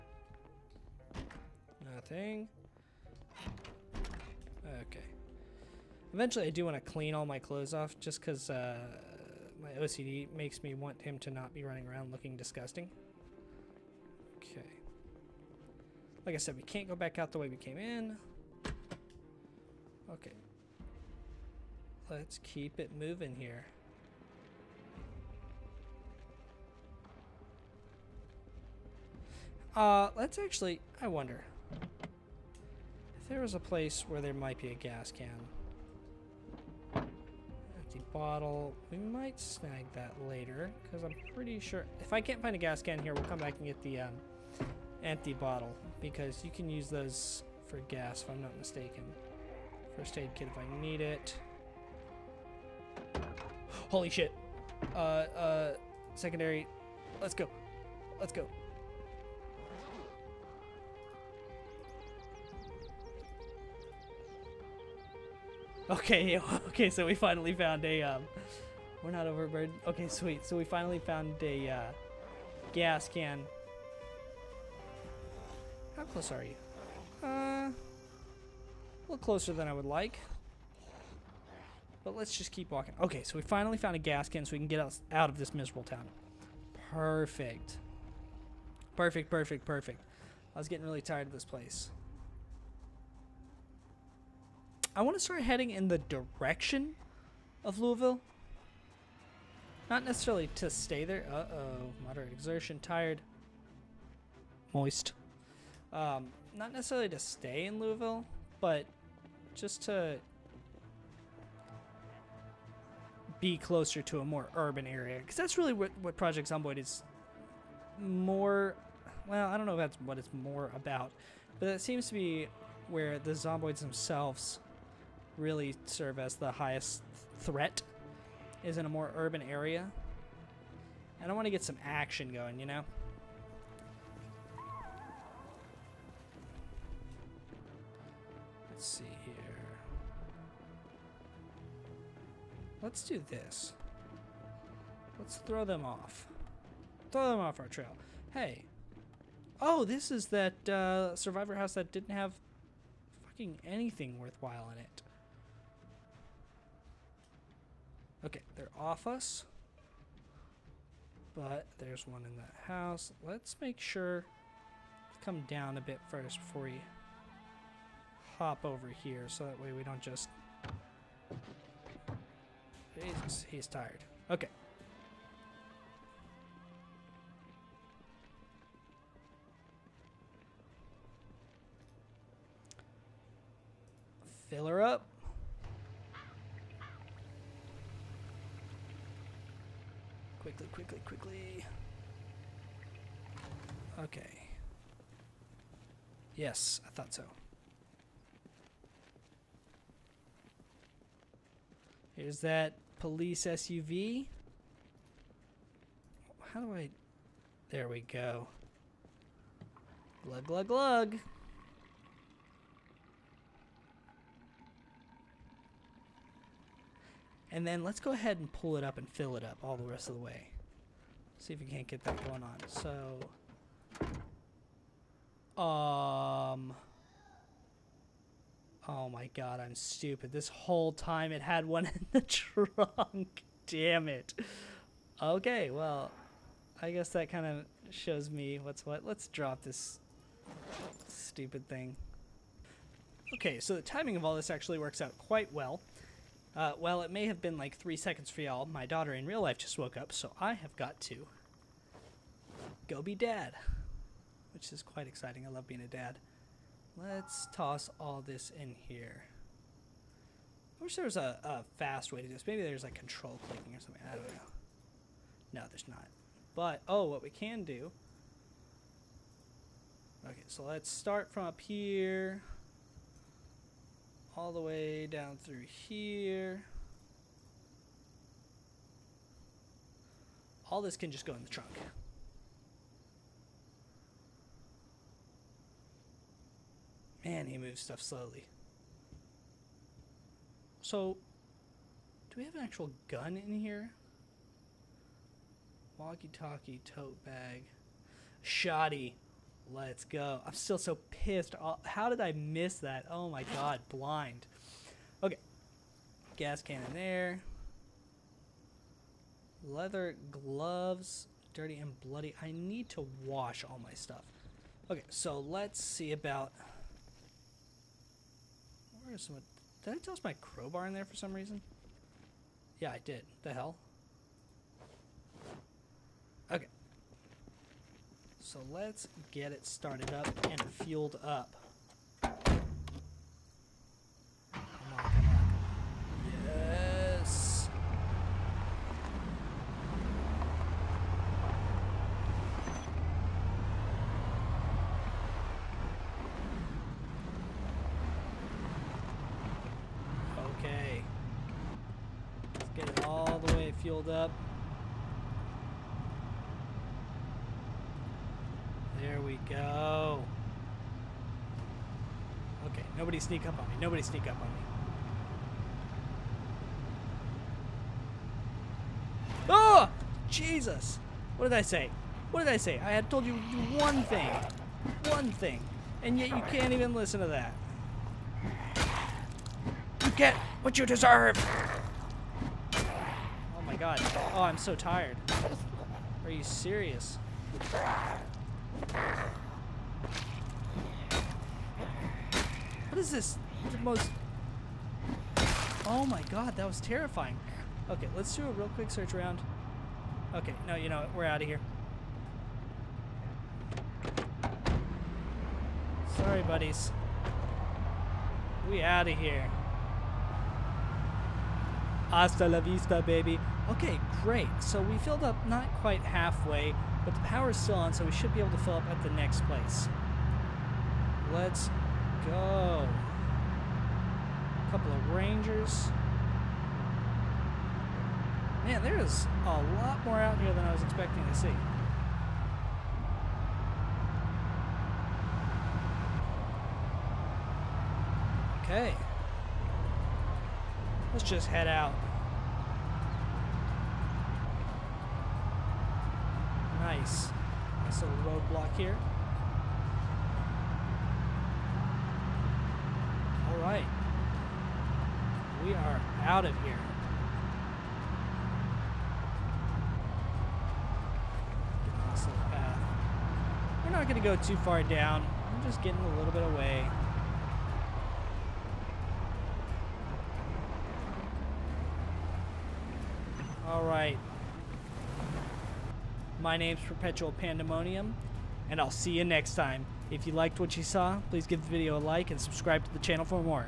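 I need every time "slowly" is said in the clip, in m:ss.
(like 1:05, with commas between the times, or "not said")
4:48.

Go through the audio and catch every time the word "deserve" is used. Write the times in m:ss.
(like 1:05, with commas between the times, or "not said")
6:20.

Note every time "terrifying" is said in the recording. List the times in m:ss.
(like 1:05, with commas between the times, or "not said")
6:36.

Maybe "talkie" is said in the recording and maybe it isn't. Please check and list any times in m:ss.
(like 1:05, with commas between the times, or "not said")
4:55.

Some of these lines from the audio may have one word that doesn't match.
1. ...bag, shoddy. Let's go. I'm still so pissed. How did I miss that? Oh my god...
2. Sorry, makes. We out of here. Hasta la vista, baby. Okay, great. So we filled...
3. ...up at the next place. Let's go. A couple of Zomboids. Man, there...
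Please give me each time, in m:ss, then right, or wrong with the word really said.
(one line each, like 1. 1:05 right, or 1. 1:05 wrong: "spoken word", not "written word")
1. 4:57 right
2. 6:46 wrong: "buddies", not "makes"
3. 6:58 wrong: "Rangers", not "Zomboids".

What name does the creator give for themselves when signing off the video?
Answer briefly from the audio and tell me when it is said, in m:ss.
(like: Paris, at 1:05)
Perpetual Pandemonium, at 7:56.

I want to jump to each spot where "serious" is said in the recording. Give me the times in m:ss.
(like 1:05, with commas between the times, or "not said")
6:26.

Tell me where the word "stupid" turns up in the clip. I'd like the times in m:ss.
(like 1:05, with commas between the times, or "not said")
3:49, 4:01.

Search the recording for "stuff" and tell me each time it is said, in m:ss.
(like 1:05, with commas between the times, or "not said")
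4:47, 5:13.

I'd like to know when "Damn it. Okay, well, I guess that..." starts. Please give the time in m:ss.
3:53.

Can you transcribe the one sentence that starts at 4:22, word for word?
Maybe there's like control clicking or something.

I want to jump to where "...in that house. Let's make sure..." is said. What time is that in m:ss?
2:42.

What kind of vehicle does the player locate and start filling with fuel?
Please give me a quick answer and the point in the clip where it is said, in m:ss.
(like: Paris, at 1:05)
Police SUV, at 3:22.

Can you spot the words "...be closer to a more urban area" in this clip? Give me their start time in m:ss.
1:53.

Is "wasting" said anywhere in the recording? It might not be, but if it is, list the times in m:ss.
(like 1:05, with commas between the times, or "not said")
not said.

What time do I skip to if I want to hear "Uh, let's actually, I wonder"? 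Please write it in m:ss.
0:29.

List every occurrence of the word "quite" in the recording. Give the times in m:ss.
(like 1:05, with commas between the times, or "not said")
4:05, 4:14, 6:55.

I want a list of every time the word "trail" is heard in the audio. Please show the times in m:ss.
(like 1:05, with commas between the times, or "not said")
2:27.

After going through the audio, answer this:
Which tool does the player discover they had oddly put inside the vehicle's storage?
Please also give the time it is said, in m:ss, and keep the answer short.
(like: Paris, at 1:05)
Crowbar, at 5:20.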